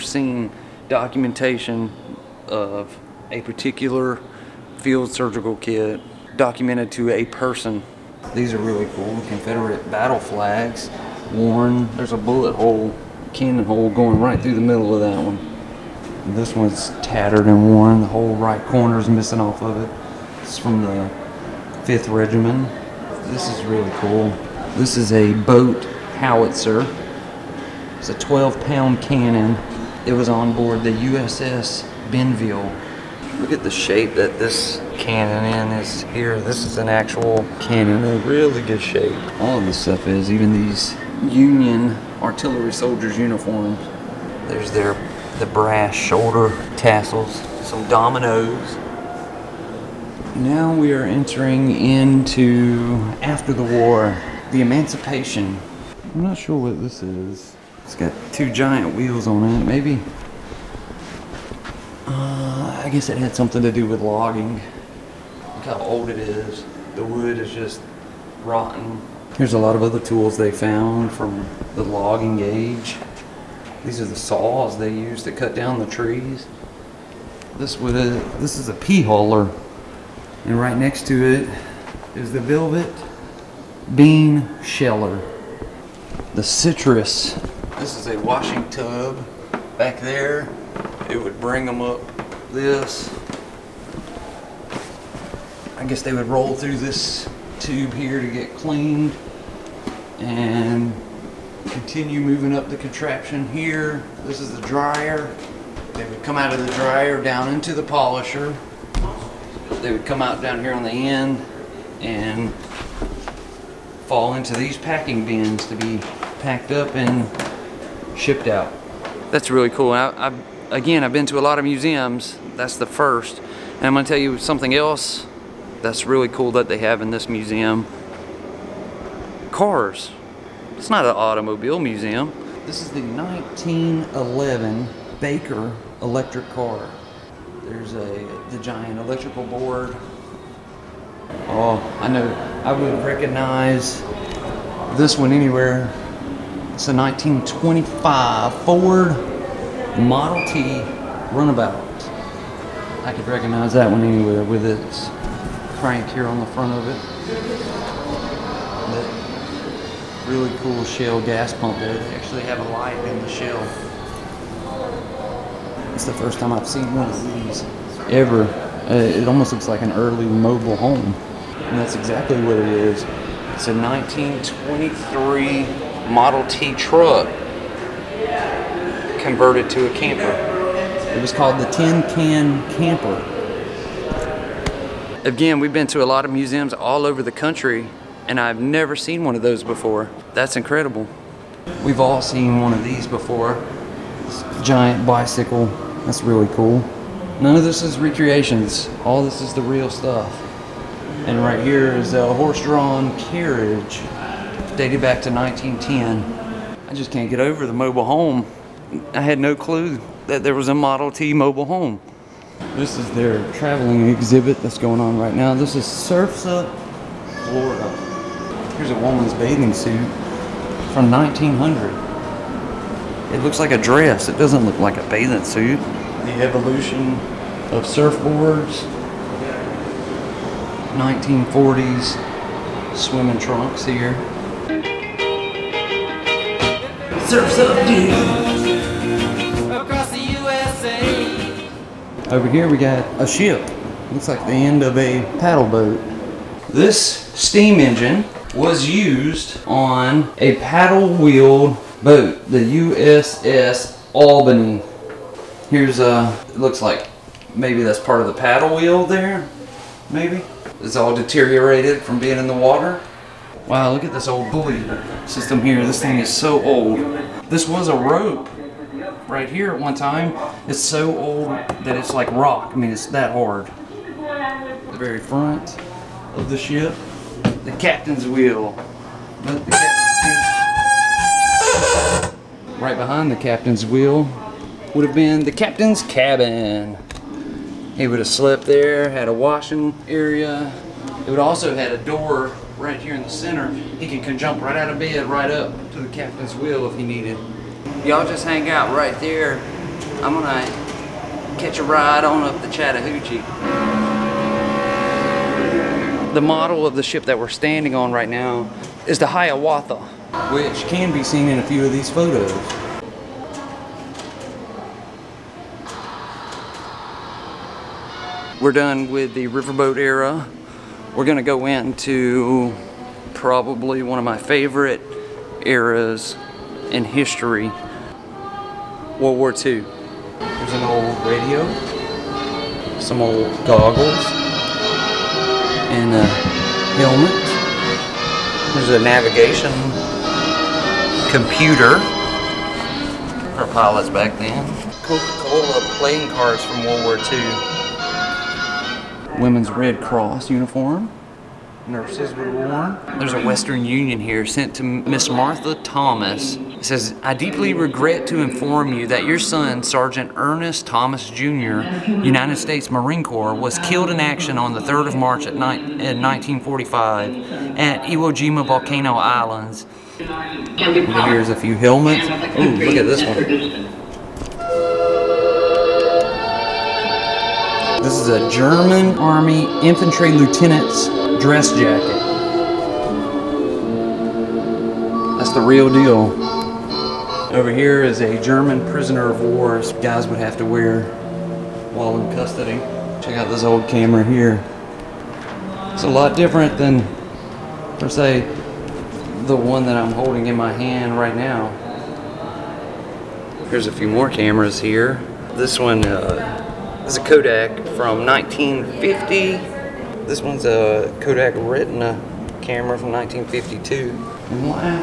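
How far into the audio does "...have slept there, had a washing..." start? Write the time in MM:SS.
04:48.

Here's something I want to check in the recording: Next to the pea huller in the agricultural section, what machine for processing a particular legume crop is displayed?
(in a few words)
velvet bean sheller.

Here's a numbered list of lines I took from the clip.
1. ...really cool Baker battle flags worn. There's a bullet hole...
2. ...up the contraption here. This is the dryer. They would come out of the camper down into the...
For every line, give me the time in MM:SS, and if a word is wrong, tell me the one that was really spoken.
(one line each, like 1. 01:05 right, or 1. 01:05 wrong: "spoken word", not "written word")
1. 00:08 wrong: "Confederate", not "Baker"
2. 01:42 wrong: "dryer", not "camper".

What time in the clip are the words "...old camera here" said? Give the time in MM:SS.
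06:33.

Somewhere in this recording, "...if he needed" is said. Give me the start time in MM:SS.
04:56.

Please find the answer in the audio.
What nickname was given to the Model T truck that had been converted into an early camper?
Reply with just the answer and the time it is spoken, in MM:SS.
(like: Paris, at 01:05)
Tin Can Camper, at 03:01.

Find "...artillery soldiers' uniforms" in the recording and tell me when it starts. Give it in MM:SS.
00:42.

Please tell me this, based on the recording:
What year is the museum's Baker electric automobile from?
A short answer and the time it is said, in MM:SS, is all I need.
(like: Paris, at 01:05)
1911, at 02:12.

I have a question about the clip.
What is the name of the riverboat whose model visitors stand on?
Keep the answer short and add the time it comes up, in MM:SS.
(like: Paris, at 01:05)
Hiawatha, at 05:09.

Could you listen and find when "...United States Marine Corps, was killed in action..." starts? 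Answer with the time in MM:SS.
06:02.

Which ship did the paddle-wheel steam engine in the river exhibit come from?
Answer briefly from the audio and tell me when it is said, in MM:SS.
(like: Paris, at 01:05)
USS Albany, at 04:12.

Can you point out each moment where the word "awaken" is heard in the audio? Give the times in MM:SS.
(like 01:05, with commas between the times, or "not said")
not said.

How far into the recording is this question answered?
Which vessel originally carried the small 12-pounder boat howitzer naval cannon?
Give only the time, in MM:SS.
00:30.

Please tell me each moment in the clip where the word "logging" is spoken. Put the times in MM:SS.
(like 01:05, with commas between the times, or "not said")
01:04, 01:11.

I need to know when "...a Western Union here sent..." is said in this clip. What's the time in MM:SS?
05:53.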